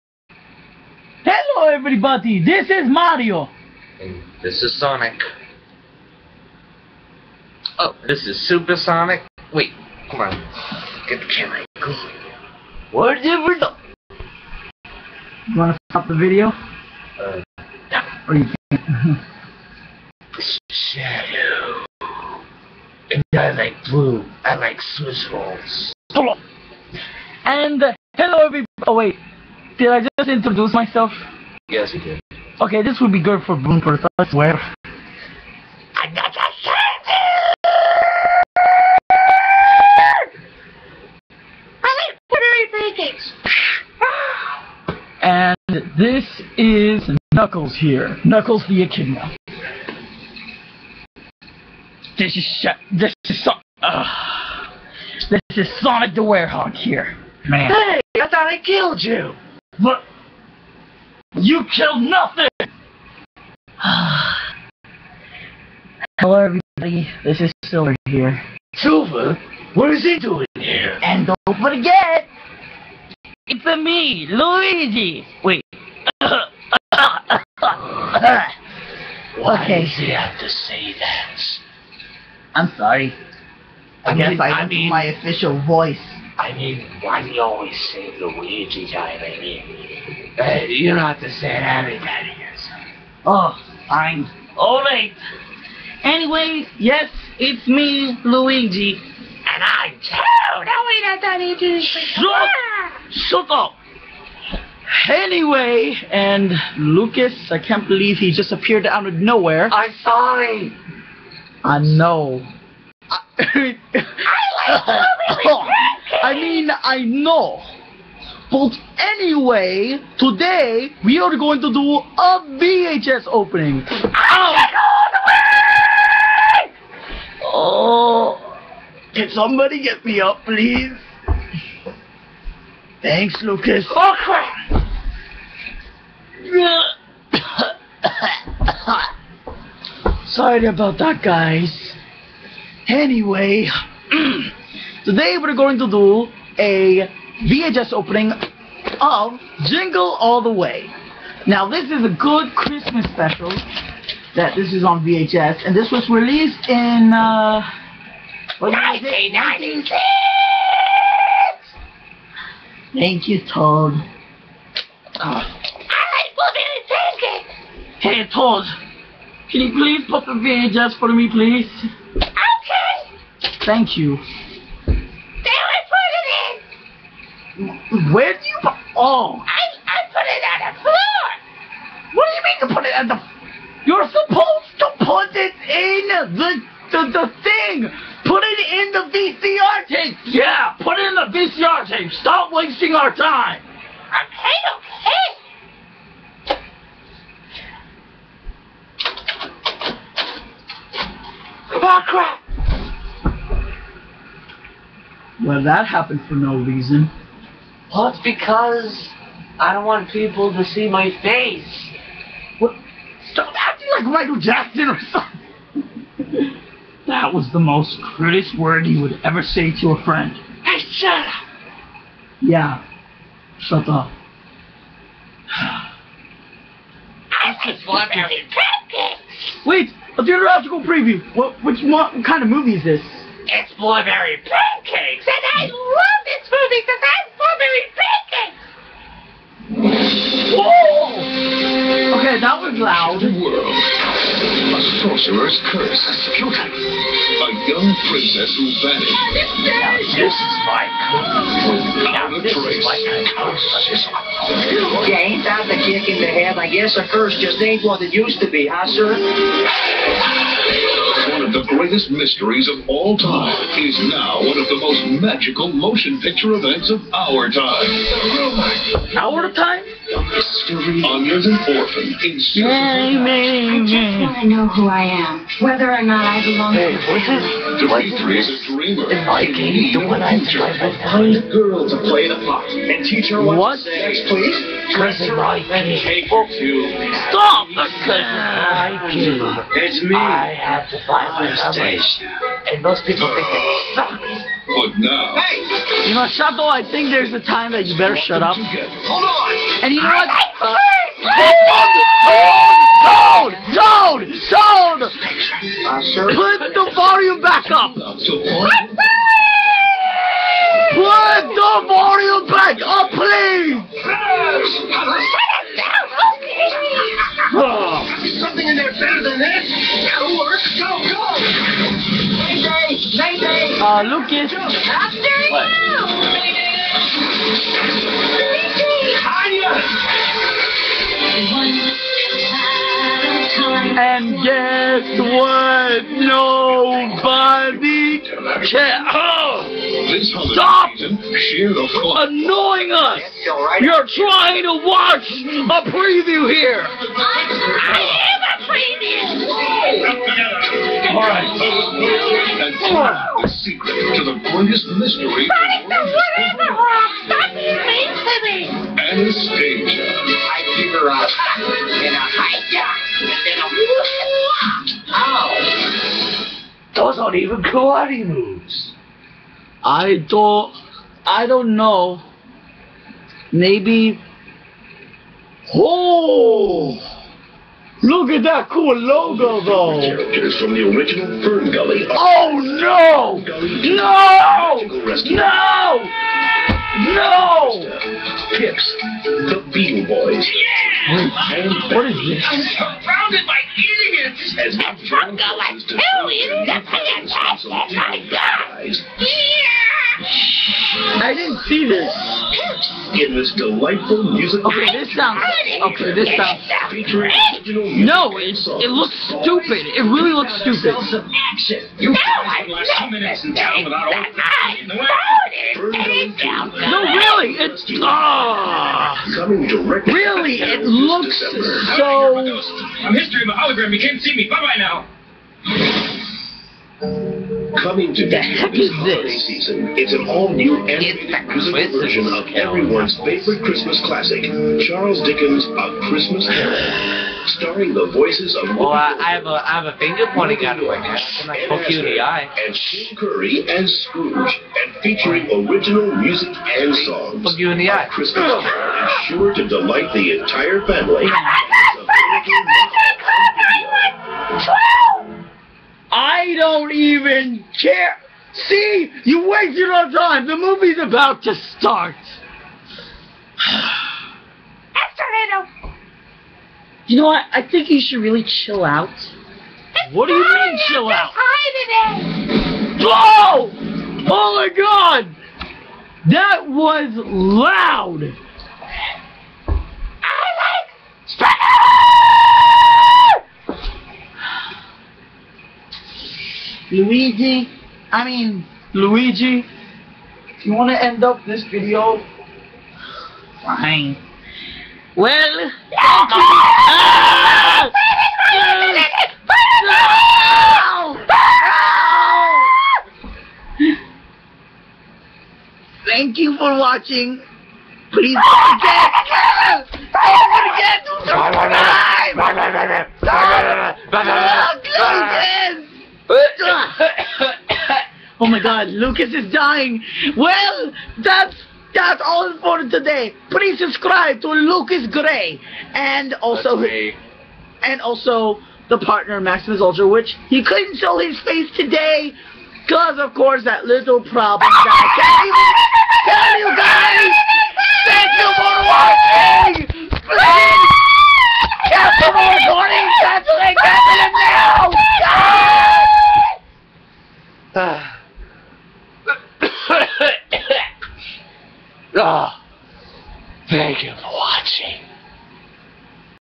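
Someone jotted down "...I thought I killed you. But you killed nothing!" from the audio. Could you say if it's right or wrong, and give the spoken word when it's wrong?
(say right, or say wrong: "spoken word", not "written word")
right.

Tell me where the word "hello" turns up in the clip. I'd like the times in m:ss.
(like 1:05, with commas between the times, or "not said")
0:01, 0:28, 1:06.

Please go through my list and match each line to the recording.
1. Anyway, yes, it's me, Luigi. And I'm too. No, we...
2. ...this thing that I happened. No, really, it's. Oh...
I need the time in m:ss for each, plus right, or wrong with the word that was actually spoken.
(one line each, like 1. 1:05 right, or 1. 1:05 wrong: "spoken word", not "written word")
1. 1:36 right
2. 6:53 wrong: "voted", not "happened".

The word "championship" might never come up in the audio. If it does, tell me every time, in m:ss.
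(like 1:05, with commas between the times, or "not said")
not said.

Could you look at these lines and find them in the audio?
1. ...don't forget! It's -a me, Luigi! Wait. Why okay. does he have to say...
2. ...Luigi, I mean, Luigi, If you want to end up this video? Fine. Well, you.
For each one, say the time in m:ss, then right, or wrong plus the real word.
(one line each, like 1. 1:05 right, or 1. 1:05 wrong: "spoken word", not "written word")
1. 1:11 right
2. 8:07 right.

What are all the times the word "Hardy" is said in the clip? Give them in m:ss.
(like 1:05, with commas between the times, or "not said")
not said.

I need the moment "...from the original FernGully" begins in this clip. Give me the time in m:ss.
6:20.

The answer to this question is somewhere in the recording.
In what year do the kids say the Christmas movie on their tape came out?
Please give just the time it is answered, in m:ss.
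2:38.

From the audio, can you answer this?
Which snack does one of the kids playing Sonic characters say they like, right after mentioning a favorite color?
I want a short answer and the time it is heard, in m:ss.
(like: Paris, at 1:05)
Swiss rolls, at 0:24.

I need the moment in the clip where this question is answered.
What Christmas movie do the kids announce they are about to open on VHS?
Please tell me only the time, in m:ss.
2:29.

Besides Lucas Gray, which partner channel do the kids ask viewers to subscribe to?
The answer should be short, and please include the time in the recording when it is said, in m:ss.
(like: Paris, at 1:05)
Maximus Ultra, at 8:49.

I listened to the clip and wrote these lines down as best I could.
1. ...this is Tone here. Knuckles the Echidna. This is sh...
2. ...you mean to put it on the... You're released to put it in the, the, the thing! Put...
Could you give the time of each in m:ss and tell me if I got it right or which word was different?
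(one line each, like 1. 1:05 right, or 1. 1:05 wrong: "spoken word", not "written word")
1. 0:45 wrong: "Knuckles", not "Tone"
2. 3:02 wrong: "supposed", not "released".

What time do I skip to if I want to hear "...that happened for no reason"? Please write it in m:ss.
3:25.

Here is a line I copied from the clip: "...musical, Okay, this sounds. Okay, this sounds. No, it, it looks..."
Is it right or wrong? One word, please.
right.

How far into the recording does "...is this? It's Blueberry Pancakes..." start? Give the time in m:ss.
3:52.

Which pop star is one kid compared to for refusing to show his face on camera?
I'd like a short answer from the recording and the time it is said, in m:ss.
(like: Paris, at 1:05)
Michael Jackson, at 3:34.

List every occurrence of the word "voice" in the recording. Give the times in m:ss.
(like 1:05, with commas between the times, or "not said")
1:25, 7:18.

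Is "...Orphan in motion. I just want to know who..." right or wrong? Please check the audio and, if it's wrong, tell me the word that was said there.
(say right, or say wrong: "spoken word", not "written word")
wrong: "season", not "motion".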